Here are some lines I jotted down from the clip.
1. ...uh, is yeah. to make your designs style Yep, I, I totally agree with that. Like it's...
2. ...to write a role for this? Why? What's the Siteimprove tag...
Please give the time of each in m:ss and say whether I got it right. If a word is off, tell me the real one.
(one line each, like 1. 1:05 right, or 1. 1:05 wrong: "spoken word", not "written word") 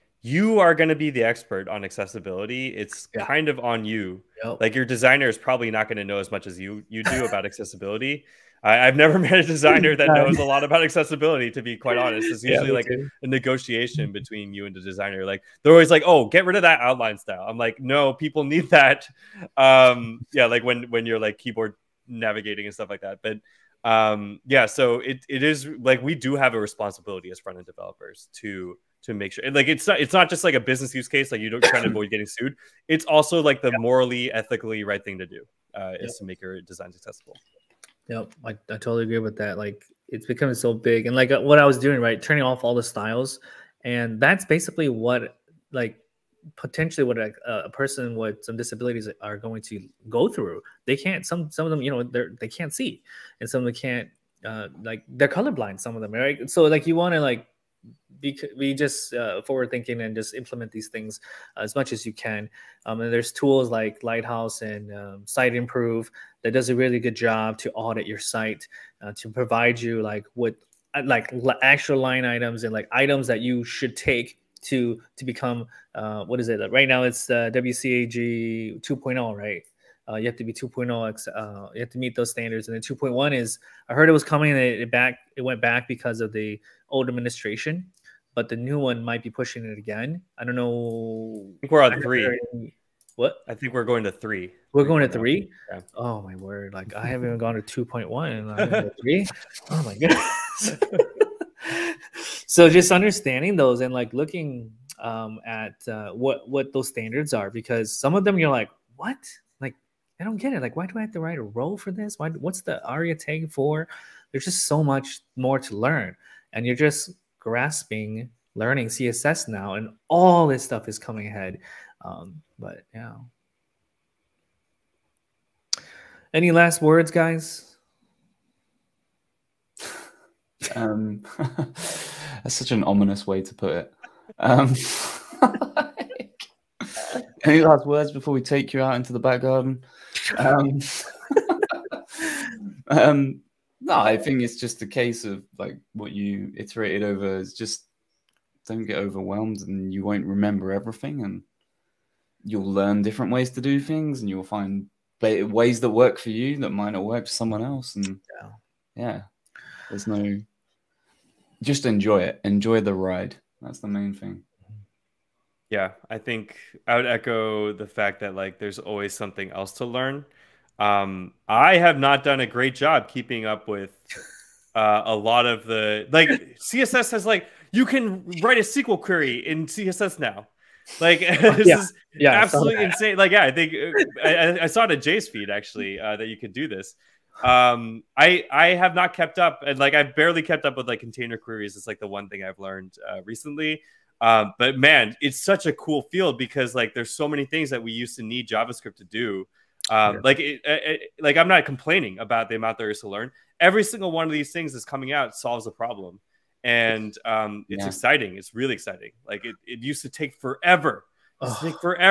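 1. 0:35 wrong: "accessible", not "style"
2. 1:51 wrong: "ARIA", not "Siteimprove".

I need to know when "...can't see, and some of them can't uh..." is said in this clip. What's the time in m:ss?
0:52.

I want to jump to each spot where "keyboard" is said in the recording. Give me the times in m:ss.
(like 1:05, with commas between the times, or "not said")
0:21.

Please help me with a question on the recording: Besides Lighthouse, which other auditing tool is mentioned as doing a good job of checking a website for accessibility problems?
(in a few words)
Siteimprove.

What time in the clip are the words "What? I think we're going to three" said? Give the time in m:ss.
1:33.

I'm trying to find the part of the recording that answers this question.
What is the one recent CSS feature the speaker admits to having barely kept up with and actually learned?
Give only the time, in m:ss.
3:10.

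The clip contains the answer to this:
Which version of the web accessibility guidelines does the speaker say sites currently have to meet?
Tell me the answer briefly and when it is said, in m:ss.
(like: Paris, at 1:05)
WCAG 2.0, at 1:17.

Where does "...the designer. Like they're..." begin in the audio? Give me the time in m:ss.
0:14.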